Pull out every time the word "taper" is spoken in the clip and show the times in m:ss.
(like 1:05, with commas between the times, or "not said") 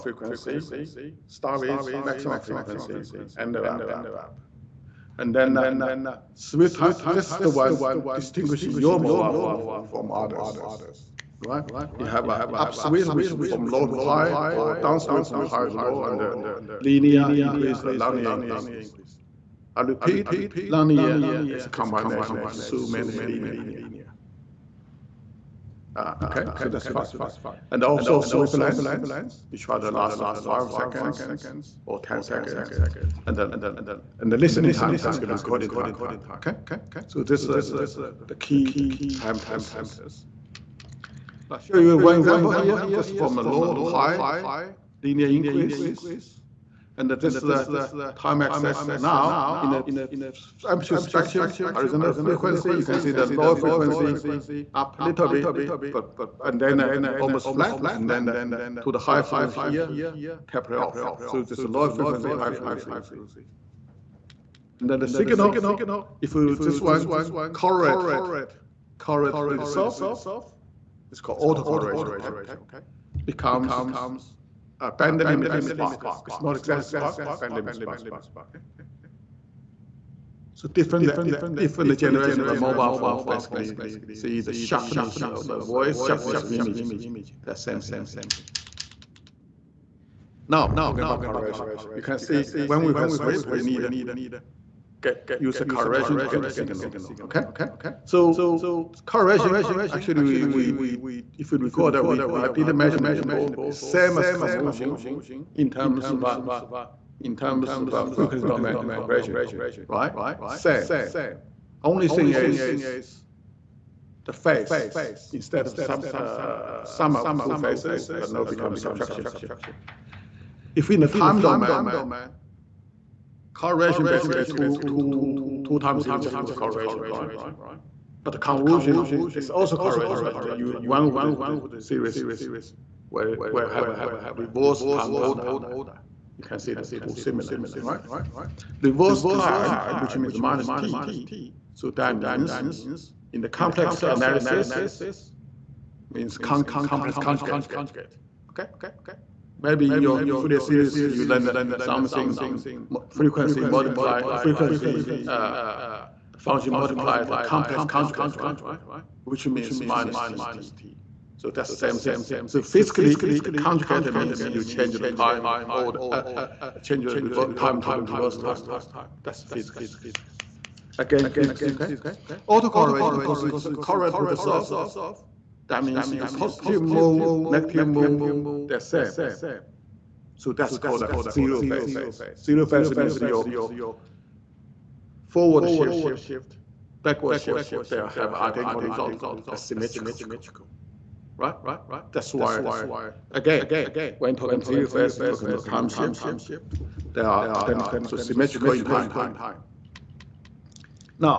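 1:00.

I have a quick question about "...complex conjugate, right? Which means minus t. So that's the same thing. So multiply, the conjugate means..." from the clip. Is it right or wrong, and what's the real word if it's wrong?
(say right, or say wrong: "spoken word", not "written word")
wrong: "physically", not "multiply".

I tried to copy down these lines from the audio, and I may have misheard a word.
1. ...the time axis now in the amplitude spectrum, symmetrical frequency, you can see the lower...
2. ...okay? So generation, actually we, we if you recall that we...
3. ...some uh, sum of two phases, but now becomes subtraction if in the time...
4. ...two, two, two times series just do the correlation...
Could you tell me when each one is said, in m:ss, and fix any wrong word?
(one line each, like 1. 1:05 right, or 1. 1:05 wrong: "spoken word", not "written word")
1. 0:47 wrong: "horizontal", not "symmetrical"
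2. 1:37 wrong: "correlation", not "generation"
3. 1:55 right
4. 2:04 right.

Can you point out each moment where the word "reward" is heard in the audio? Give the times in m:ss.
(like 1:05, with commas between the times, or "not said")
not said.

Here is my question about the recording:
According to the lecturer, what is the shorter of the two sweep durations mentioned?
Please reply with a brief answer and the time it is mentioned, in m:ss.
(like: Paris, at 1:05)
5 seconds, at 0:30.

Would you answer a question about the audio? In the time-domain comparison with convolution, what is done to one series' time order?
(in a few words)
reverse time order.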